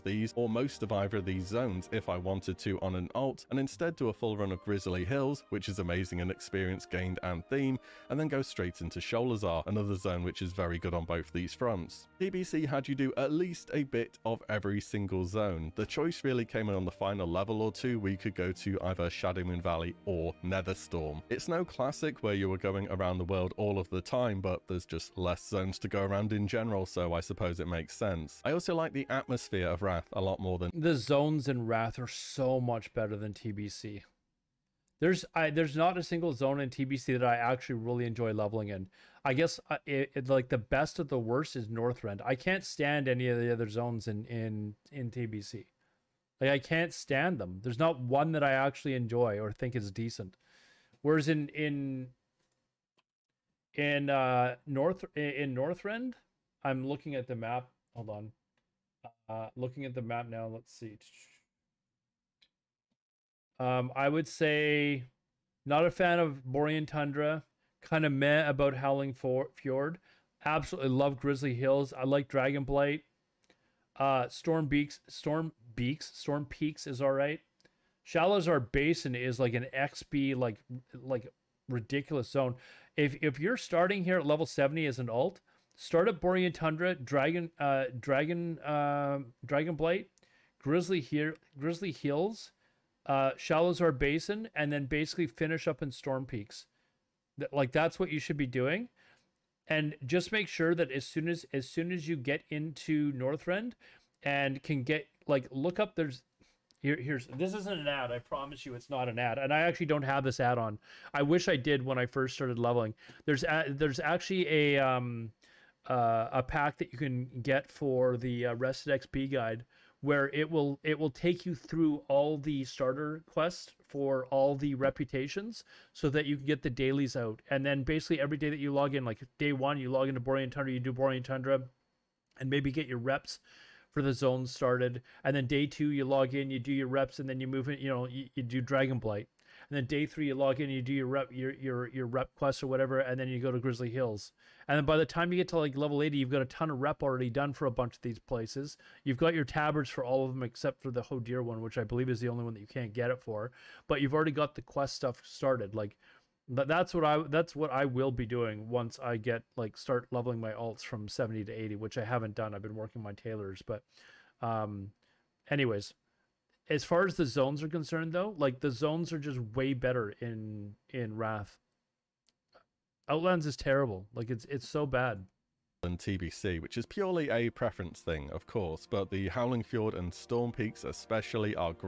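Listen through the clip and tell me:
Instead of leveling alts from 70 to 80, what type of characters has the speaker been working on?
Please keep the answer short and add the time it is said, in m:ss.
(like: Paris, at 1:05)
Tailors, at 2:43.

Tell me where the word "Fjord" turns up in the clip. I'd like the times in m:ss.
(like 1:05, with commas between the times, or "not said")
1:09, 2:59.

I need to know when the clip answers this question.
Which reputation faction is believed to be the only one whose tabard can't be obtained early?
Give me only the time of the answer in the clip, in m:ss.
2:31.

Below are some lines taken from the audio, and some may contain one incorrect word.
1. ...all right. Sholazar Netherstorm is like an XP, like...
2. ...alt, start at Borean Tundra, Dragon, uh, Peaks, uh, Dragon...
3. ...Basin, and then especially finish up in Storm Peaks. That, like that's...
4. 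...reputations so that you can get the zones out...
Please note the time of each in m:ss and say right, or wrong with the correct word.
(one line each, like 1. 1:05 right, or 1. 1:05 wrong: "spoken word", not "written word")
1. 1:17 wrong: "Basin", not "Netherstorm"
2. 1:25 wrong: "Dragon", not "Peaks"
3. 1:33 wrong: "basically", not "especially"
4. 2:04 wrong: "dailies", not "zones".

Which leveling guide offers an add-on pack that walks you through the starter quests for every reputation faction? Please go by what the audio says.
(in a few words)
Rested XP.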